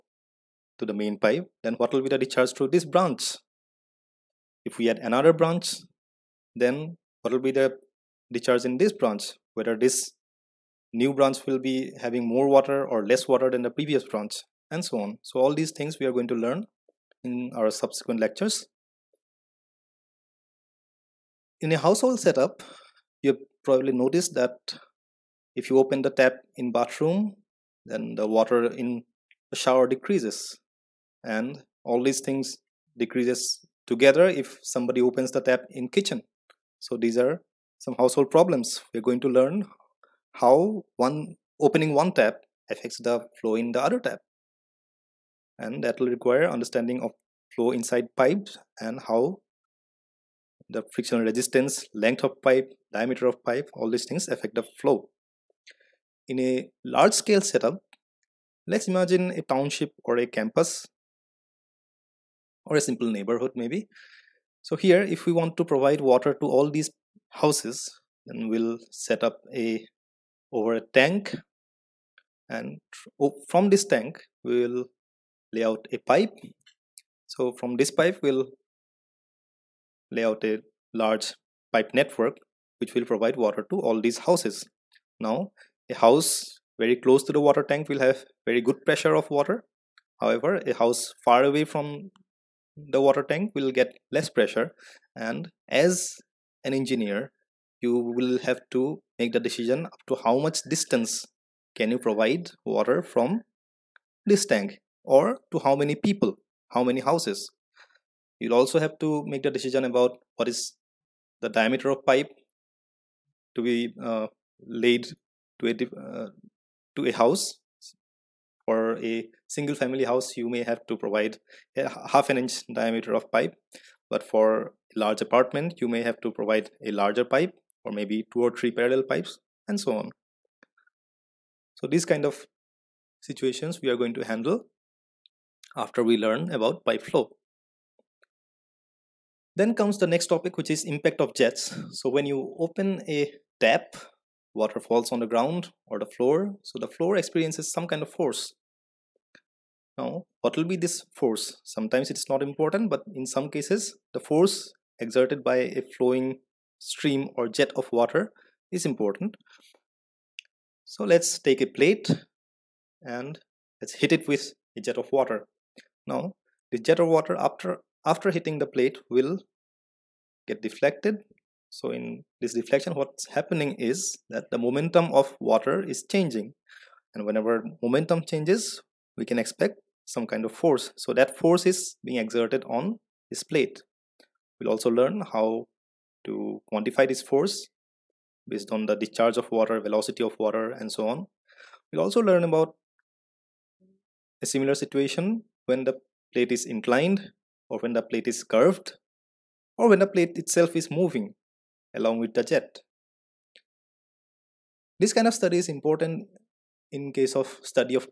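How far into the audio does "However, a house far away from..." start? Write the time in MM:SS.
01:30.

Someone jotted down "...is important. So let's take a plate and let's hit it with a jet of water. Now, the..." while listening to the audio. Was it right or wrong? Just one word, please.
right.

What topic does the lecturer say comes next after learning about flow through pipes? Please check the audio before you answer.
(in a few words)
Impact of jets.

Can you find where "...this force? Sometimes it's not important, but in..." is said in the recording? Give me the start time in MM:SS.
02:30.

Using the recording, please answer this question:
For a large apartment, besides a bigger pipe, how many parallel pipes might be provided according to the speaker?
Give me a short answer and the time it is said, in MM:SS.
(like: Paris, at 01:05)
2 or 3, at 02:08.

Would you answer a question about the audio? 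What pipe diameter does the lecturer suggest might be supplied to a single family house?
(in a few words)
Half an inch.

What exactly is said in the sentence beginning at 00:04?
If we add another branch, then what will be the discharge in this branch?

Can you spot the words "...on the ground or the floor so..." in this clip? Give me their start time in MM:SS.
02:25.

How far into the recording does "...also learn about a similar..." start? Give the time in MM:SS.
03:12.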